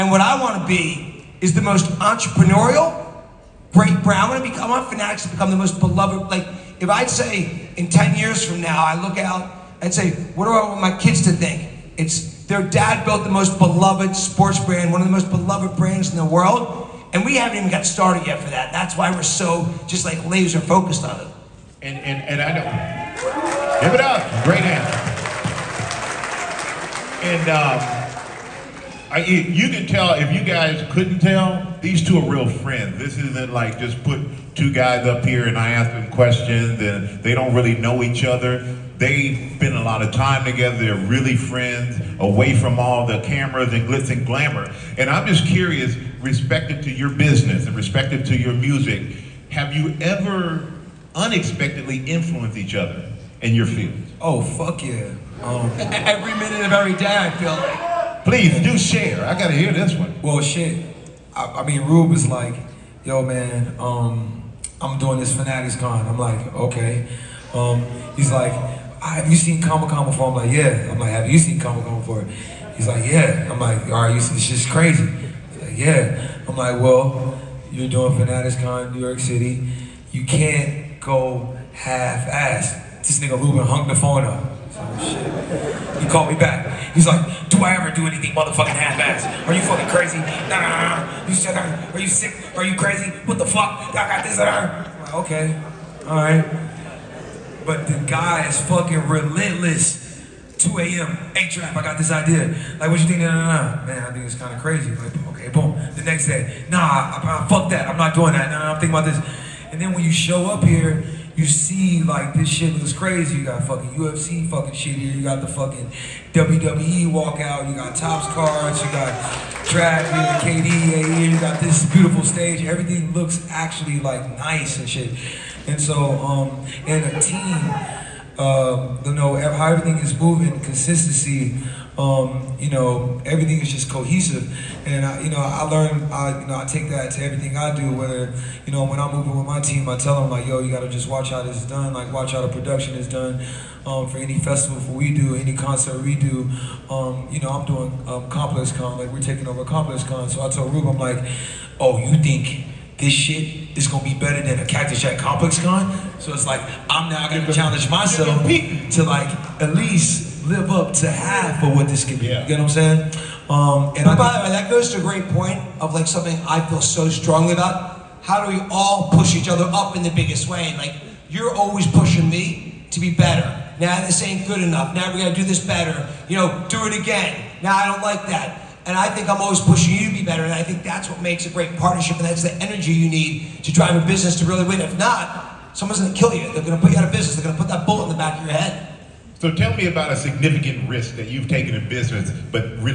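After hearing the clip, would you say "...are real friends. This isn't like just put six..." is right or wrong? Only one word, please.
wrong.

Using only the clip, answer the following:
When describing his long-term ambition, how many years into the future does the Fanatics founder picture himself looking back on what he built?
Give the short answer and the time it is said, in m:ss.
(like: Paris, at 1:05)
10, at 0:07.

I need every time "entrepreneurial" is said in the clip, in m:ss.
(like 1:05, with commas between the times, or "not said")
0:01.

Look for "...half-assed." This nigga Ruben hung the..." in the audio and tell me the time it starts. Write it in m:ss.
1:21.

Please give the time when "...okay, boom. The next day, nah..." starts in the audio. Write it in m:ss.
1:45.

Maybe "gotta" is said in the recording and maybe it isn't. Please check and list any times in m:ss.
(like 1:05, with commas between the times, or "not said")
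0:59, 2:20, 2:55.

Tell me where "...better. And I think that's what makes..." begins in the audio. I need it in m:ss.
3:00.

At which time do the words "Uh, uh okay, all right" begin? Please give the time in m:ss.
1:34.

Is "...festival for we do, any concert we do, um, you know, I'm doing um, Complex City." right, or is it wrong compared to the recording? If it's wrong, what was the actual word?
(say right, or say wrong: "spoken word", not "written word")
wrong: "Con", not "City".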